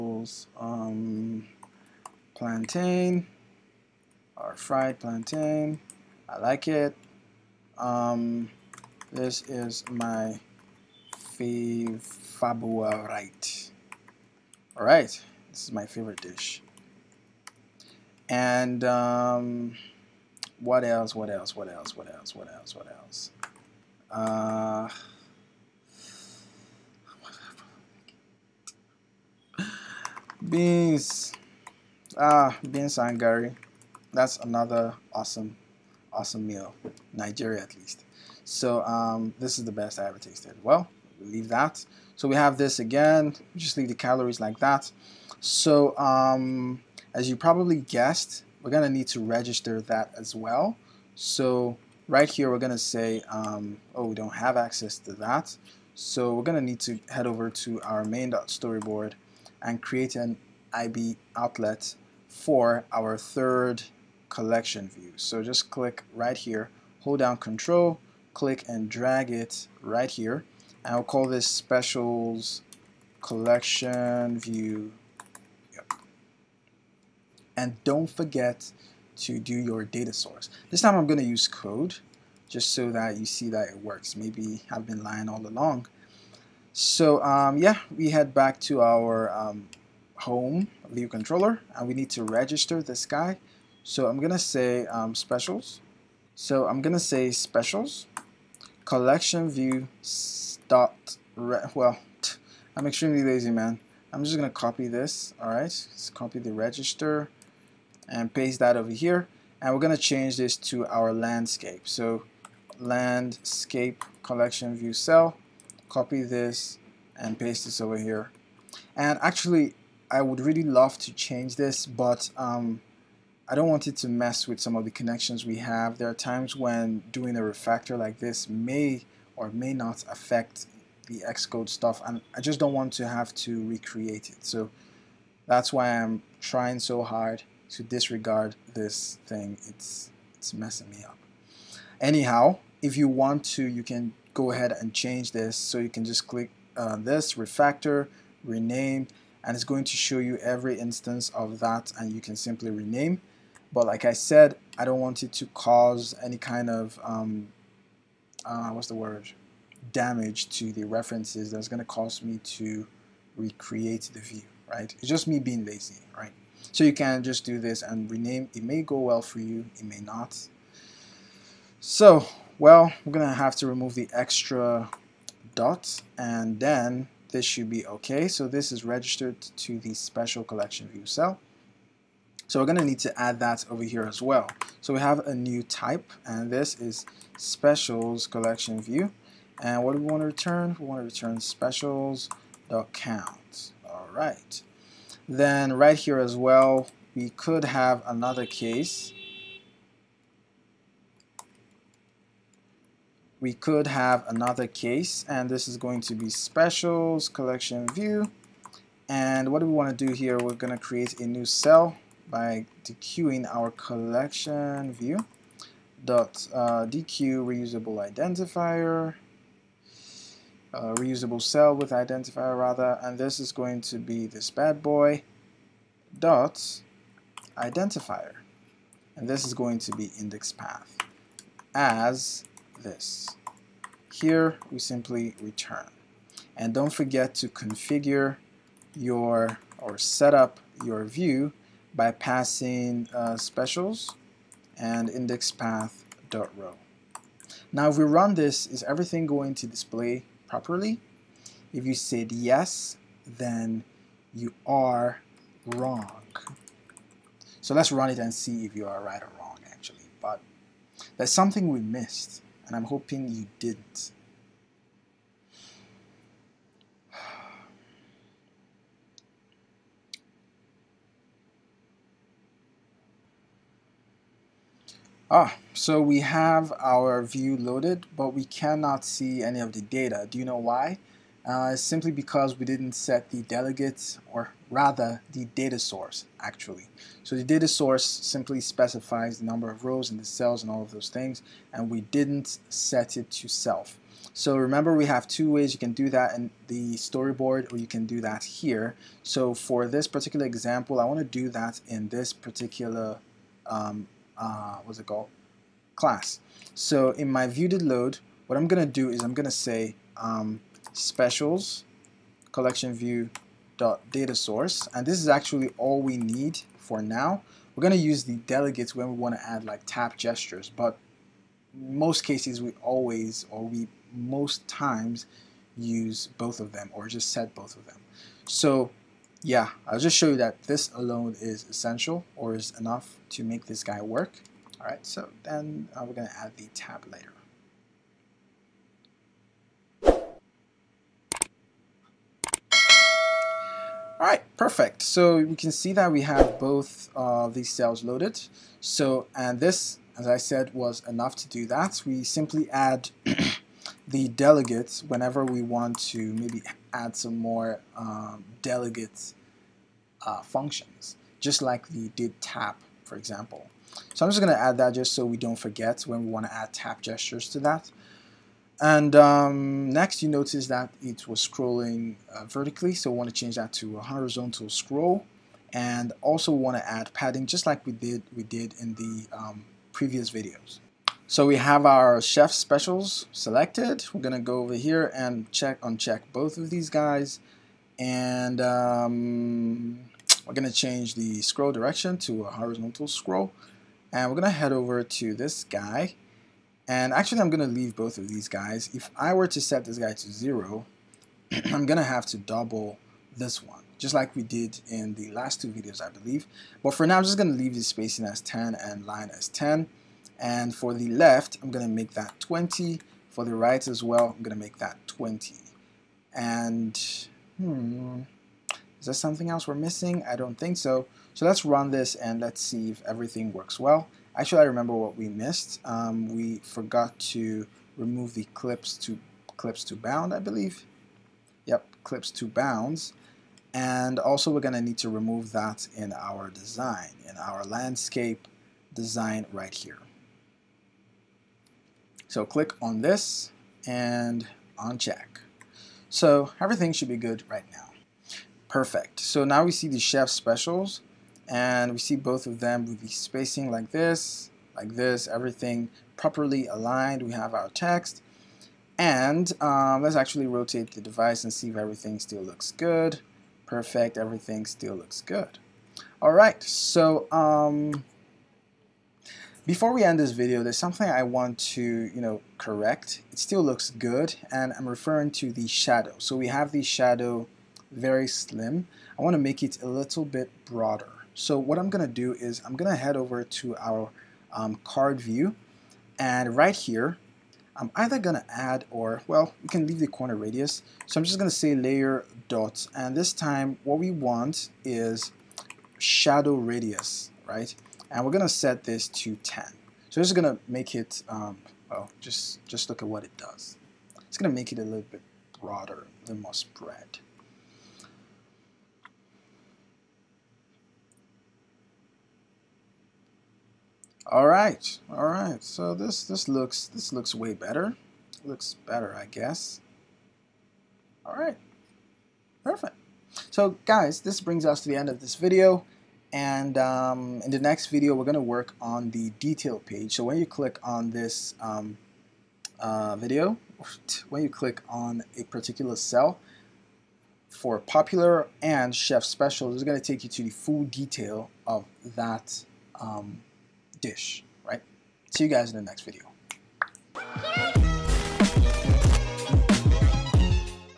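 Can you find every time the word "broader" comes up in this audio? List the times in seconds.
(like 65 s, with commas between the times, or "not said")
480 s, 505 s.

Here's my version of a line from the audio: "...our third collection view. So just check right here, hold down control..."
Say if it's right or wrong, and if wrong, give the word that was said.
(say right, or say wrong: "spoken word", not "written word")
wrong: "click", not "check".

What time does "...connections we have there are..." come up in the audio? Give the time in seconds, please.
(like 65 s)
124 s.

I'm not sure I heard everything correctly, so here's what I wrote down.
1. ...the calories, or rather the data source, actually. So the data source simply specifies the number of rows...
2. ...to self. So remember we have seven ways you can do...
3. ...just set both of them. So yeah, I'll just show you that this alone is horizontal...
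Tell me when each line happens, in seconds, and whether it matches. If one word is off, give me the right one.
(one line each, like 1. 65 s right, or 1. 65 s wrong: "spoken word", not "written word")
1. 283 s wrong: "delegates", not "calories"
2. 293 s wrong: "two", not "seven"
3. 327 s wrong: "essential", not "horizontal".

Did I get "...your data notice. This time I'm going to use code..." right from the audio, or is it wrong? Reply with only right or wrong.
wrong.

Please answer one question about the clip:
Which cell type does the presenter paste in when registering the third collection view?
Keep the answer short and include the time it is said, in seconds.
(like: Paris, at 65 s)
Landscape collection view cell, at 112 s.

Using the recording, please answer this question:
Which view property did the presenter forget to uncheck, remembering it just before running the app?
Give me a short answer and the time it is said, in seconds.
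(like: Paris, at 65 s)
Clips to bounds, at 432 s.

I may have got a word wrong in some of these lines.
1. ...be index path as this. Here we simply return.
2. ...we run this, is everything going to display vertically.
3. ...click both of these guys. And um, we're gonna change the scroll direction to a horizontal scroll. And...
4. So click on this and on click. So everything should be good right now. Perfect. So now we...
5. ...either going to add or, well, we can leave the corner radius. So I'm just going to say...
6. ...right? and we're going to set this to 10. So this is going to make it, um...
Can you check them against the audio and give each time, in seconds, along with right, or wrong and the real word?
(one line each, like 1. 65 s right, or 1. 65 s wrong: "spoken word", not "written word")
1. 229 s right
2. 247 s wrong: "properly", not "vertically"
3. 385 s wrong: "uncheck", not "click"
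4. 442 s wrong: "check", not "click"
5. 487 s right
6. 497 s right.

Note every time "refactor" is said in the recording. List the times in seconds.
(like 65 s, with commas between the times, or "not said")
127 s, 147 s.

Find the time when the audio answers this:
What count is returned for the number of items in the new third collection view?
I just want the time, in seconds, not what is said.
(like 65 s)
191 s.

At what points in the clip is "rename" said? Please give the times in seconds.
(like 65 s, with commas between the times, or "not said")
148 s, 152 s, 168 s.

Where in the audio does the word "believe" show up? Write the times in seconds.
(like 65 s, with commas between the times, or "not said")
406 s, 430 s.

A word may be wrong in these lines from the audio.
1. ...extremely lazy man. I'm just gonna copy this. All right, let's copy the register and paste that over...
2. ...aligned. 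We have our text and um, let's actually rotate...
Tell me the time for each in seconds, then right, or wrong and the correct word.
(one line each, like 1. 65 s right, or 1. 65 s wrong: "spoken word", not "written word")
1. 102 s right
2. 456 s right.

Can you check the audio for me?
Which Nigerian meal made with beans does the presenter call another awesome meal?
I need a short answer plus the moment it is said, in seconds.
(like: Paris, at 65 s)
Beans and garri, at 32 s.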